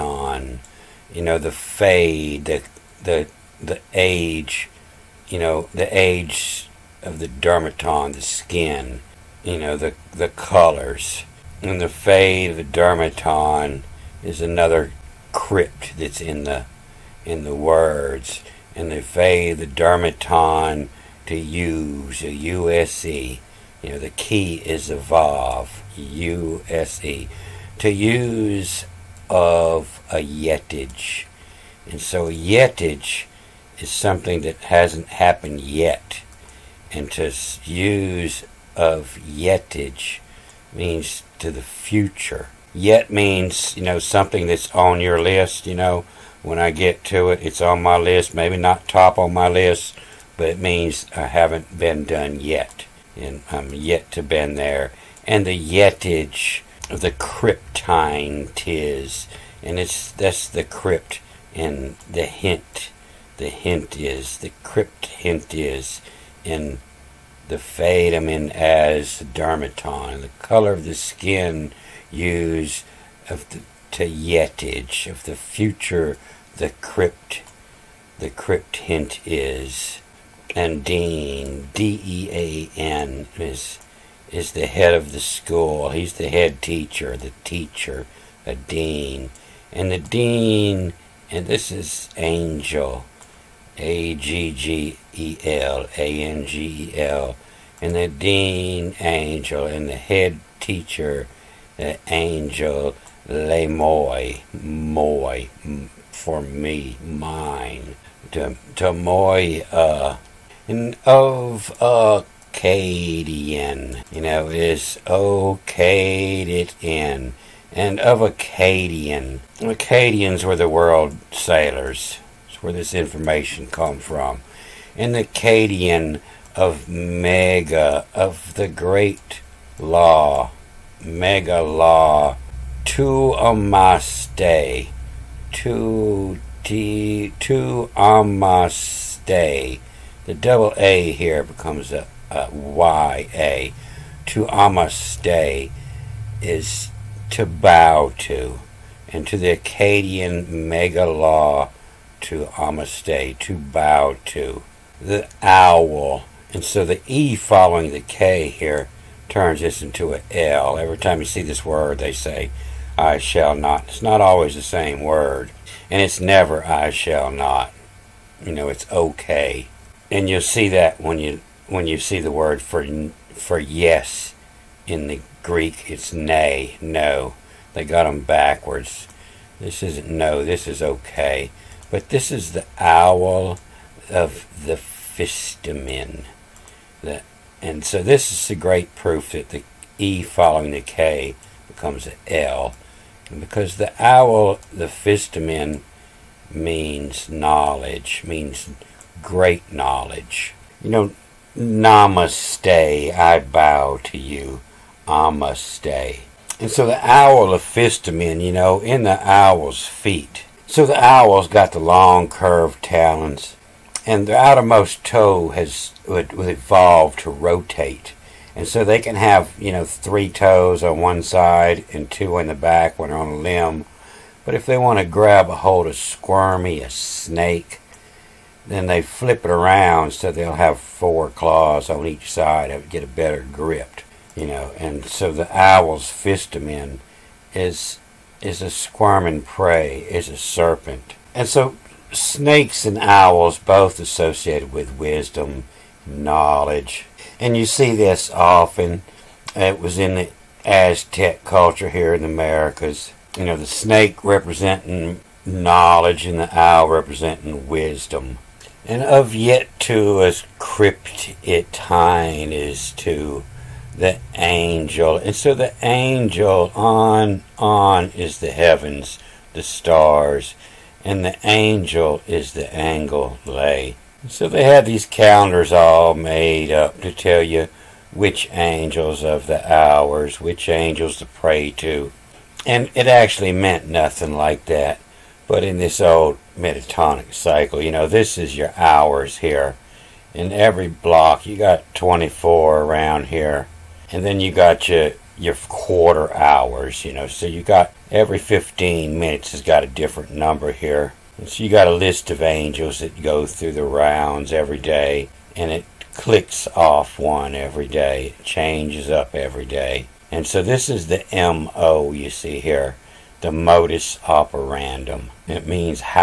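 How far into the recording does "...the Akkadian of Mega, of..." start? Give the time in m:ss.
2:05.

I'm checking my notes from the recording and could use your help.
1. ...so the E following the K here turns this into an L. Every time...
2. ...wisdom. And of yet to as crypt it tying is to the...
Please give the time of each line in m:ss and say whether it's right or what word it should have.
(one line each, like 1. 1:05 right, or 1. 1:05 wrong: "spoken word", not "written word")
1. 2:36 right
2. 4:17 right.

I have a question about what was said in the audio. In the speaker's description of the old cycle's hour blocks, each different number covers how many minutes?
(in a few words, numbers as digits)
15.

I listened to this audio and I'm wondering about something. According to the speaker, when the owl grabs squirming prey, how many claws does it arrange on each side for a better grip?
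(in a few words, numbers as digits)
4.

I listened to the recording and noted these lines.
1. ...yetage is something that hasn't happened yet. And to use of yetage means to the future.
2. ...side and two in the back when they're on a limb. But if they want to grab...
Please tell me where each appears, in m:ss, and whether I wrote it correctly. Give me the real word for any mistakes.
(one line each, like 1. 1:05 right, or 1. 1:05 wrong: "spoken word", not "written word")
1. 0:32 right
2. 3:41 right.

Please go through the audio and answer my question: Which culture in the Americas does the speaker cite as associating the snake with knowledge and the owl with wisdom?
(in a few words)
Aztec.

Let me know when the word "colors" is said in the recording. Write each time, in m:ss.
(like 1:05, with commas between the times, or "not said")
0:10, 1:10.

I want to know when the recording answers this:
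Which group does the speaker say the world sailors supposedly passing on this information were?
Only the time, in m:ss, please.
1:59.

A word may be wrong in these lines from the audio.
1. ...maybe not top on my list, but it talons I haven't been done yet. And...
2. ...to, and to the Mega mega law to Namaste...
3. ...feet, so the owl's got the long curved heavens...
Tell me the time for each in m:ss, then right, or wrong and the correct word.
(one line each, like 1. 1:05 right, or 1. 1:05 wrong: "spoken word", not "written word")
1. 0:48 wrong: "means", not "talons"
2. 2:28 wrong: "Akkadian", not "Mega"
3. 3:29 wrong: "talons", not "heavens".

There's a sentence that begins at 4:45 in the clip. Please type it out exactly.
But in this old metatonic cycle, you know, this is your hours here.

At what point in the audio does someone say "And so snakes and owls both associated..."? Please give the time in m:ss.
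4:01.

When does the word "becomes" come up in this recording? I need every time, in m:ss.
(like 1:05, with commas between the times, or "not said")
2:21, 3:11.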